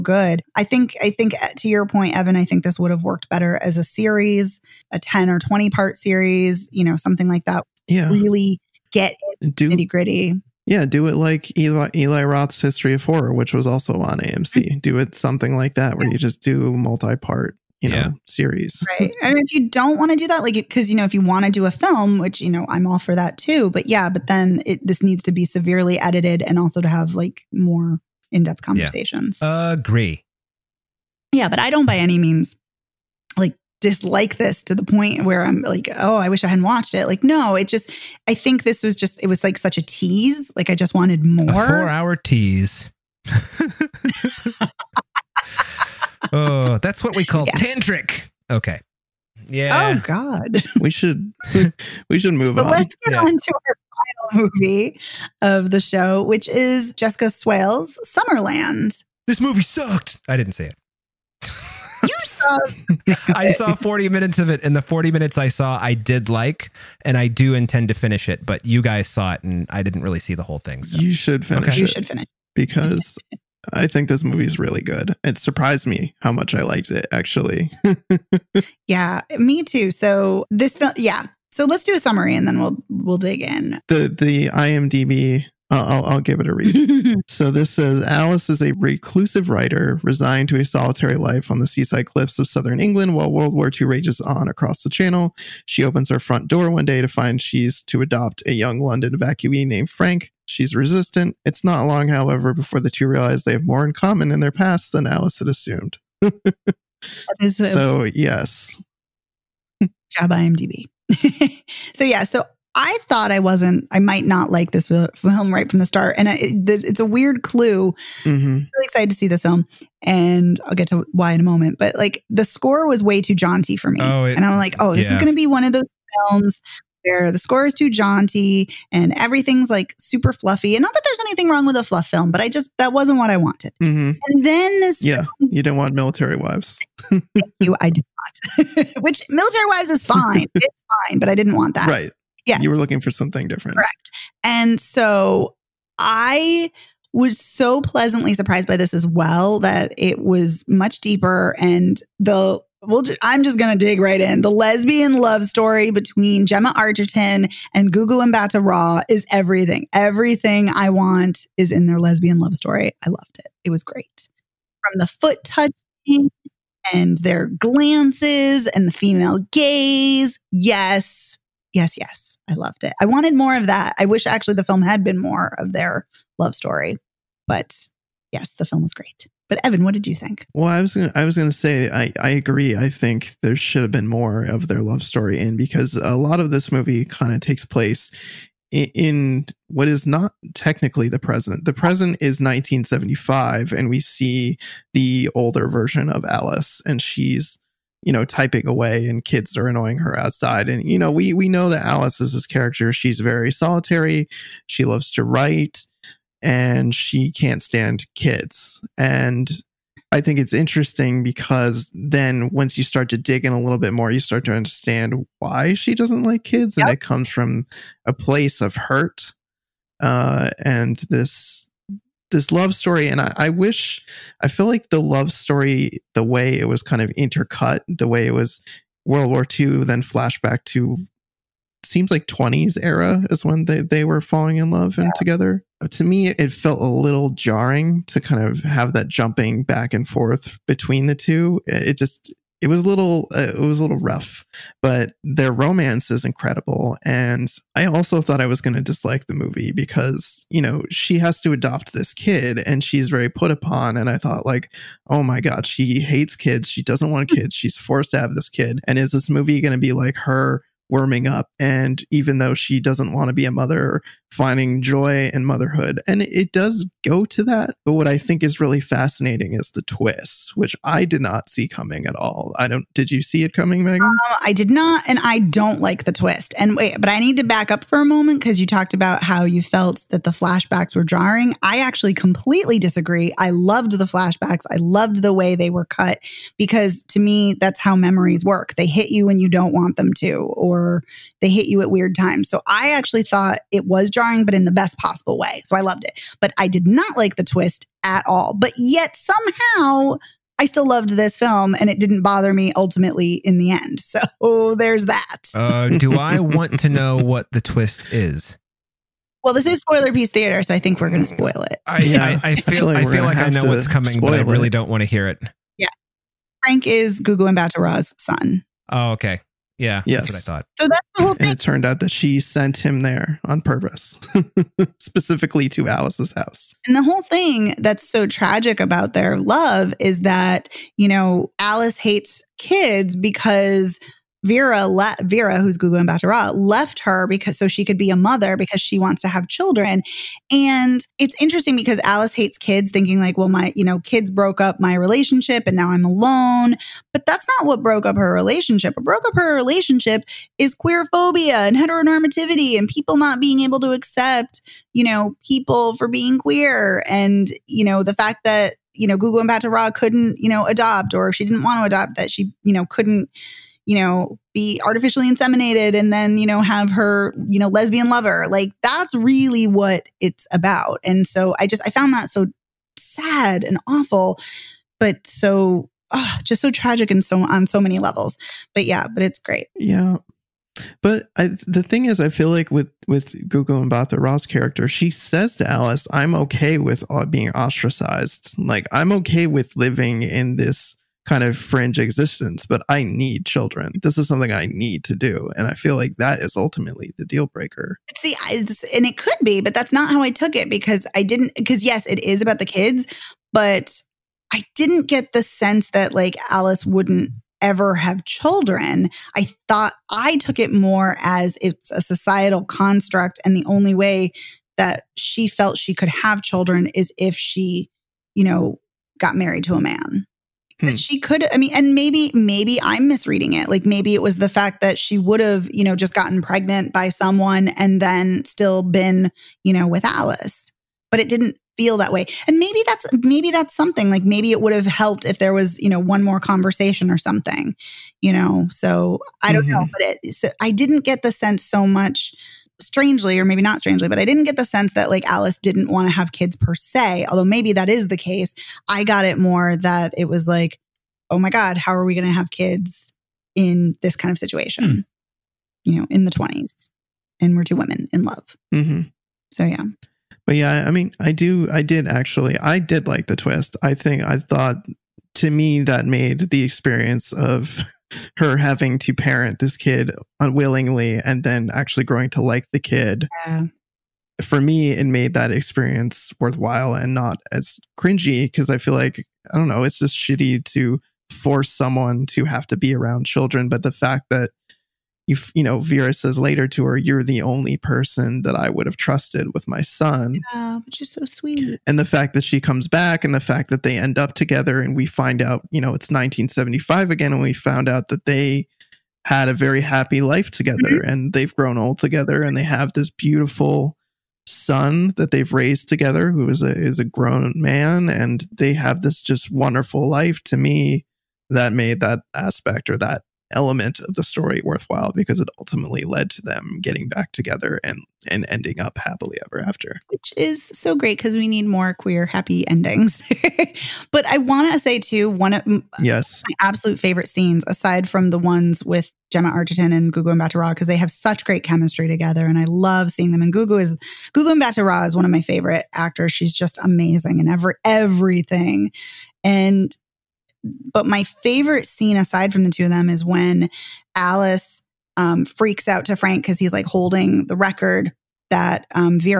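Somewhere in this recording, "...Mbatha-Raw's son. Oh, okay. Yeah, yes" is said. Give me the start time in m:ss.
5:17.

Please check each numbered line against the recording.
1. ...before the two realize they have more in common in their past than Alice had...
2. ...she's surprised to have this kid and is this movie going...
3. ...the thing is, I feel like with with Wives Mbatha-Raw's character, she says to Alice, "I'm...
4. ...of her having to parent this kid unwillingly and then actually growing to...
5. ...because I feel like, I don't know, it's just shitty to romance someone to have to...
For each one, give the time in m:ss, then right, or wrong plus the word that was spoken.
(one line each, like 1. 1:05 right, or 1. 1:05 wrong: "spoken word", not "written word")
1. 1:42 right
2. 4:17 wrong: "forced", not "surprised"
3. 6:21 wrong: "Gugu", not "Wives"
4. 7:47 right
5. 7:58 wrong: "force", not "romance".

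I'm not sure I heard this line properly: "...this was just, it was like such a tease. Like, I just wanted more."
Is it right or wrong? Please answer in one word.
right.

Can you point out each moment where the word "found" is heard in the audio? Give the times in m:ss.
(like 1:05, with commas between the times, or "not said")
6:11, 8:17.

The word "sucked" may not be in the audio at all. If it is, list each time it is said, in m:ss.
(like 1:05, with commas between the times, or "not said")
0:59.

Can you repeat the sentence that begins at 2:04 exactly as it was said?
Oh, it, and I'm like, oh, this yeah.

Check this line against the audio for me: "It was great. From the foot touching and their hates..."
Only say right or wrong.
wrong.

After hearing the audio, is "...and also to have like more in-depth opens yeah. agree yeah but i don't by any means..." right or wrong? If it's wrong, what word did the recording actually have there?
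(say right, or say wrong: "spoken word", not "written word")
wrong: "conversations", not "opens".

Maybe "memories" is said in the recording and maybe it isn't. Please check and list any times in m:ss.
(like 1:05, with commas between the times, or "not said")
4:47.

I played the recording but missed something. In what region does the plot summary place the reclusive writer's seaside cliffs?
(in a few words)
southern England.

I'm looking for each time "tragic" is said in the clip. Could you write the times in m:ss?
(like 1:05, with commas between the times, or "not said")
5:28, 6:16.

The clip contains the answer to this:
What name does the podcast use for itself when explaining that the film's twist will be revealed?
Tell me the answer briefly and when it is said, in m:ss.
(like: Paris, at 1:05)
Spoilerpiece Theatre, at 5:09.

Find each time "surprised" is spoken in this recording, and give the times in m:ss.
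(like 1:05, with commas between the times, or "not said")
1:15, 2:28.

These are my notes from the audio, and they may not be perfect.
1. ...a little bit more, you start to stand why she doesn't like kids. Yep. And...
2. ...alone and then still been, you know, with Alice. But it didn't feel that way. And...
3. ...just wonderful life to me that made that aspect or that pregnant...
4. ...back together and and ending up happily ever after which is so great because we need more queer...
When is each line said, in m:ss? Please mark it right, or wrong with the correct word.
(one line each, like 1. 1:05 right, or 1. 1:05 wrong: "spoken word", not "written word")
1. 3:33 wrong: "understand", not "stand"
2. 7:07 wrong: "someone", not "alone"
3. 8:29 wrong: "element", not "pregnant"
4. 8:37 right.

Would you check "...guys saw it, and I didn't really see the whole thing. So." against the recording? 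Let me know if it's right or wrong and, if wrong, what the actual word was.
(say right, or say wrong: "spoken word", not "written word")
right.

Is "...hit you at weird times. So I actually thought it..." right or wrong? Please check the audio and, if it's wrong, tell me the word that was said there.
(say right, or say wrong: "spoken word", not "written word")
right.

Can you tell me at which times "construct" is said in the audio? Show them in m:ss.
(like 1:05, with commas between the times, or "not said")
6:52.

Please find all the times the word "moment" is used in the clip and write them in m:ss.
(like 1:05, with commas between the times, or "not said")
2:01, 4:38.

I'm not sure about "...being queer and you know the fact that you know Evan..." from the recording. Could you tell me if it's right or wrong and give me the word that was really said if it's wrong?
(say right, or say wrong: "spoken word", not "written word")
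wrong: "Gugu", not "Evan".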